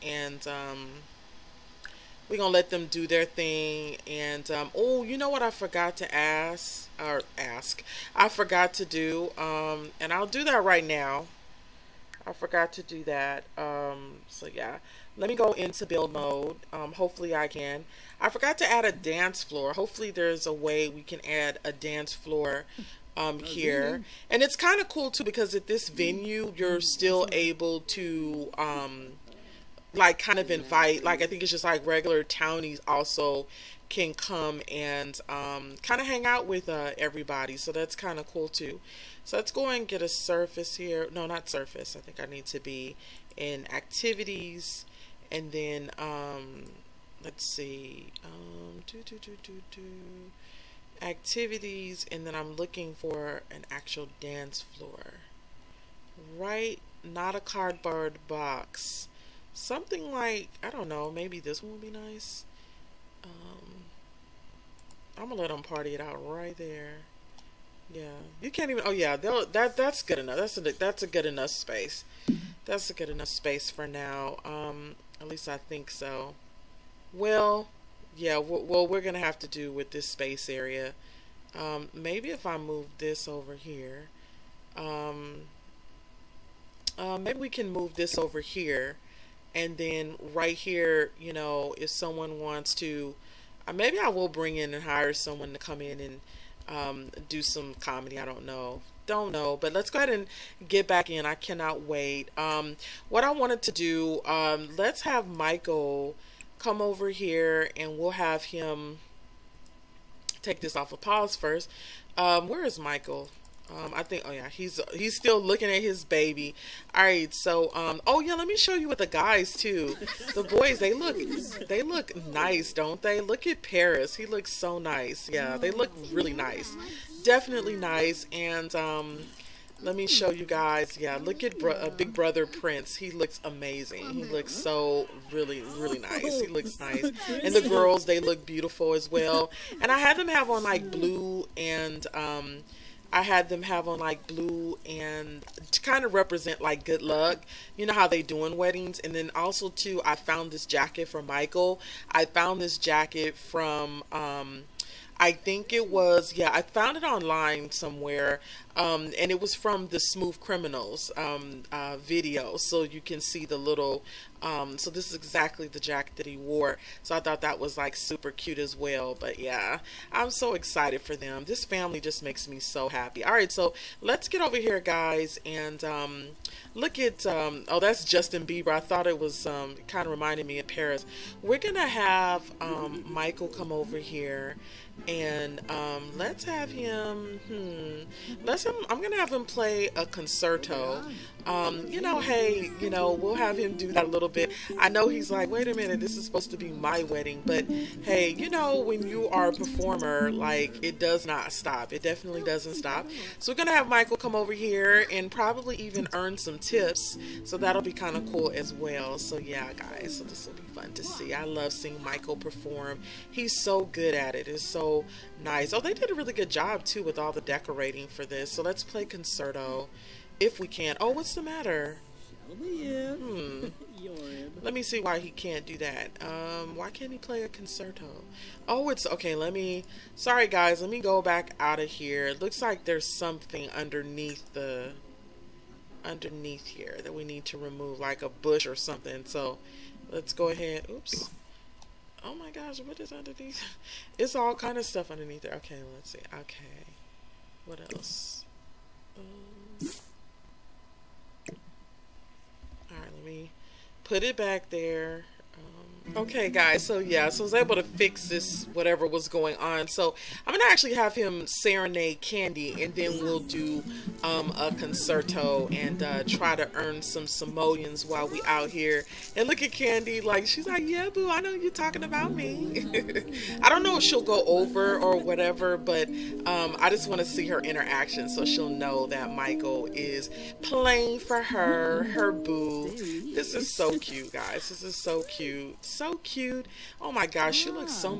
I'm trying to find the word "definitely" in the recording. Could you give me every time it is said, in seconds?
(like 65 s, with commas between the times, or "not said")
127 s, 202 s.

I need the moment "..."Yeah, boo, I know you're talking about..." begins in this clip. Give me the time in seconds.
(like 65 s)
270 s.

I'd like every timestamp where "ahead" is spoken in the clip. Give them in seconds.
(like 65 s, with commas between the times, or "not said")
99 s, 240 s.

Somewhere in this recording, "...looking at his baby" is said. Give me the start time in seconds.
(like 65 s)
115 s.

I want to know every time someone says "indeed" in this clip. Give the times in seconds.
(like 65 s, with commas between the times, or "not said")
not said.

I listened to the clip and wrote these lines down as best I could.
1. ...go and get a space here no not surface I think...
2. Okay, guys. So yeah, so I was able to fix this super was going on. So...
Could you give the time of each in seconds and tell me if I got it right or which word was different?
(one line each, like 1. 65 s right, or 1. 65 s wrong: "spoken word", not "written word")
1. 39 s wrong: "surface", not "space"
2. 256 s wrong: "whatever", not "super".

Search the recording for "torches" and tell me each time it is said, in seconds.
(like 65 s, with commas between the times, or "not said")
not said.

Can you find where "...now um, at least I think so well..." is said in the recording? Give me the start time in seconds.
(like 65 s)
73 s.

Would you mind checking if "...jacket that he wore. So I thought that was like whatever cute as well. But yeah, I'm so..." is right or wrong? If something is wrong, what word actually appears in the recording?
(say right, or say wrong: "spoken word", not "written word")
wrong: "super", not "whatever".